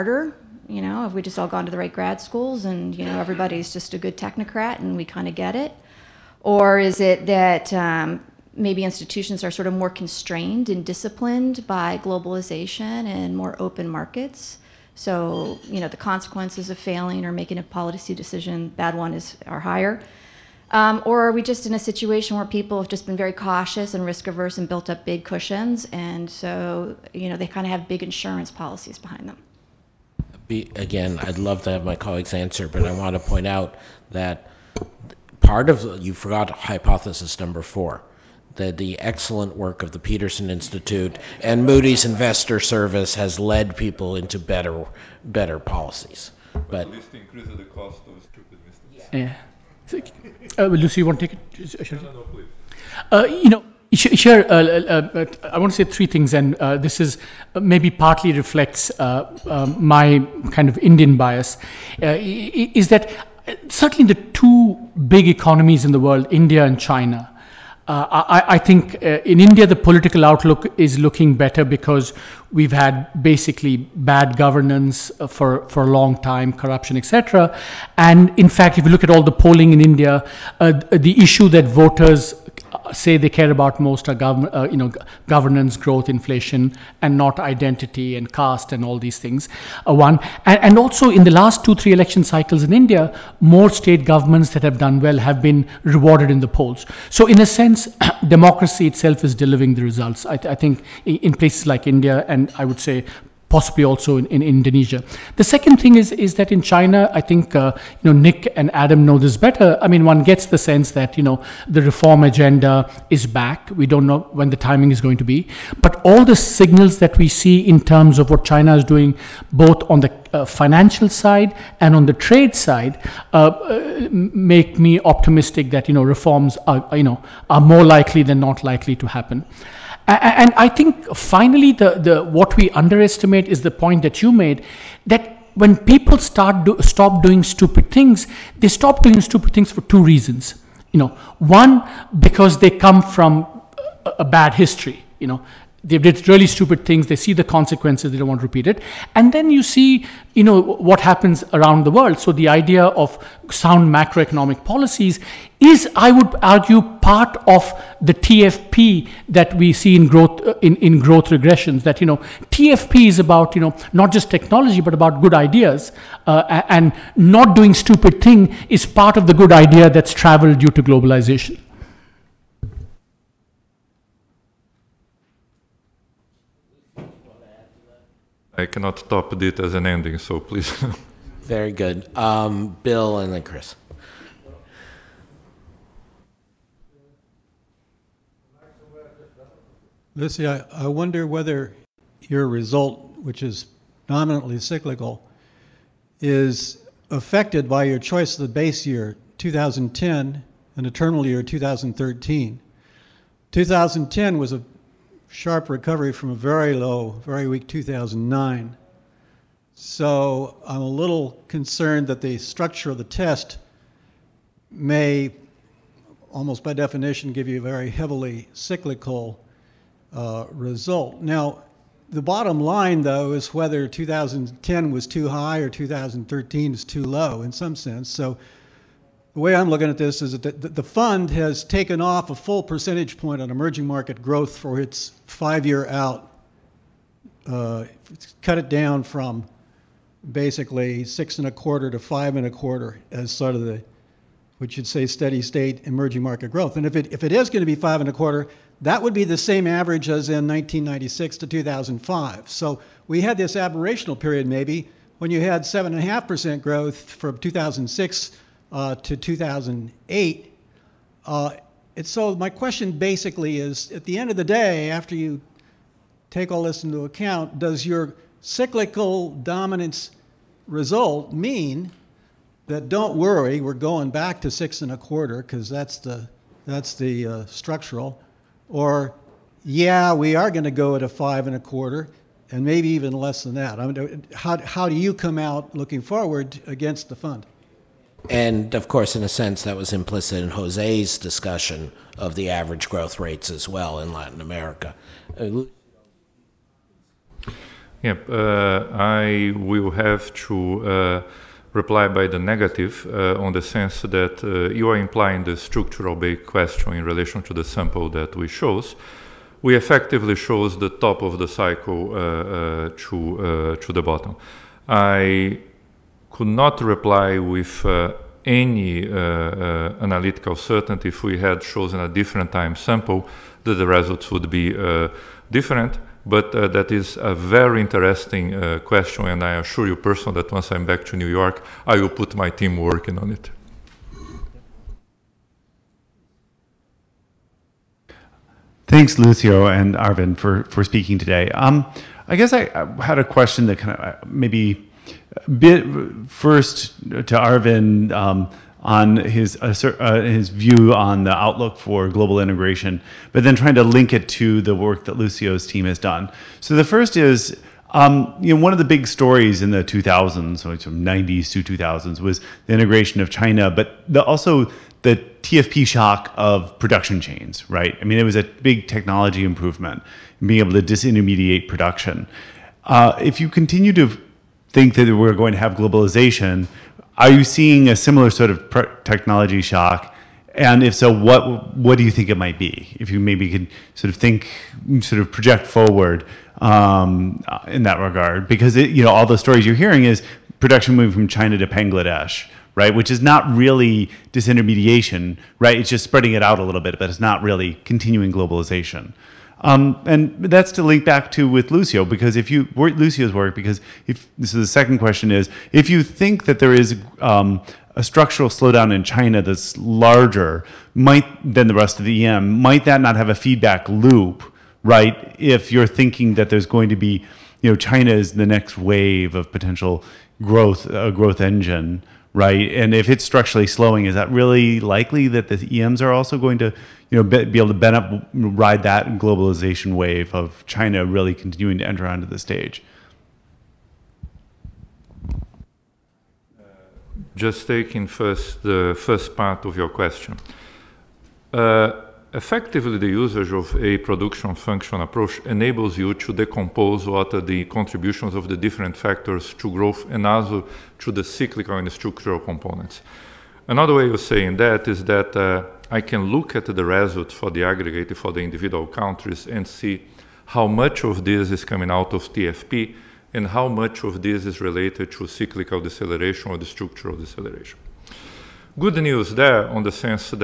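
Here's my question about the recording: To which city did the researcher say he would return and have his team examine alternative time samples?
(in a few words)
New York.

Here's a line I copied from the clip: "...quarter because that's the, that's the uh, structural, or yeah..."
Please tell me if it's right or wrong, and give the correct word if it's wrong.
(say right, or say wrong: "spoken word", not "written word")
right.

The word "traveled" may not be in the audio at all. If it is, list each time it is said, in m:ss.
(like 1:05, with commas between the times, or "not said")
2:50.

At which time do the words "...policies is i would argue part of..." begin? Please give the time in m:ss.
2:34.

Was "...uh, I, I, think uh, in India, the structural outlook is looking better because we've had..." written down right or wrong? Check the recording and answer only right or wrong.
wrong.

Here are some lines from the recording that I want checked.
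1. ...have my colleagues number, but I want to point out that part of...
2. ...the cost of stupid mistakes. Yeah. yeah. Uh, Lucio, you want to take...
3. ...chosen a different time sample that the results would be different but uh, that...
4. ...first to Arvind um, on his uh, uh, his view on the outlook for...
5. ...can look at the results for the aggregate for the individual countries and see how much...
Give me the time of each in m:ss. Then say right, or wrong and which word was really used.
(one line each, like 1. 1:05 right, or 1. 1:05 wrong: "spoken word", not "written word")
1. 0:31 wrong: "answer", not "number"
2. 0:47 right
3. 5:21 right
4. 5:46 right
5. 7:36 right.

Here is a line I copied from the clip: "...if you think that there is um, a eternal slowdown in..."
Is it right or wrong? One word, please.
wrong.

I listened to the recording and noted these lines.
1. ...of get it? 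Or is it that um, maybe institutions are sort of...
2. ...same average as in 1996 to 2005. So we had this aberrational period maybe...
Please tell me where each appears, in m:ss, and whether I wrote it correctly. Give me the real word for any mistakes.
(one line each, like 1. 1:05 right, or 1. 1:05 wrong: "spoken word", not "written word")
1. 0:05 right
2. 4:09 right.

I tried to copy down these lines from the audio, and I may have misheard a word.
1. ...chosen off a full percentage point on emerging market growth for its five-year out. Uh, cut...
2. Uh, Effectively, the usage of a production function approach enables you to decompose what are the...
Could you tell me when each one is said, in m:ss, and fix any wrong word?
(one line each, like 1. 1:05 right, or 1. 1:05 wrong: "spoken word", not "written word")
1. 3:51 wrong: "taken", not "chosen"
2. 7:21 right.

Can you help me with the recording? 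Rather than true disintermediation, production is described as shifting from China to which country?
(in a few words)
Bangladesh.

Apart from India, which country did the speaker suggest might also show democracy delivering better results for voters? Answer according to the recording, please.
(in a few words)
Indonesia.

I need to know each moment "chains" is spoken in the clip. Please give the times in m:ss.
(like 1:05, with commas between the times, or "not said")
6:07.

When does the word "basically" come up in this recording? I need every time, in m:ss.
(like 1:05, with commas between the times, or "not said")
1:13, 4:00, 4:22.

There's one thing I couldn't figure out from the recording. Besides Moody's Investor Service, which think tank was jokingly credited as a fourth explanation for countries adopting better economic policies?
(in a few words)
Peterson Institute.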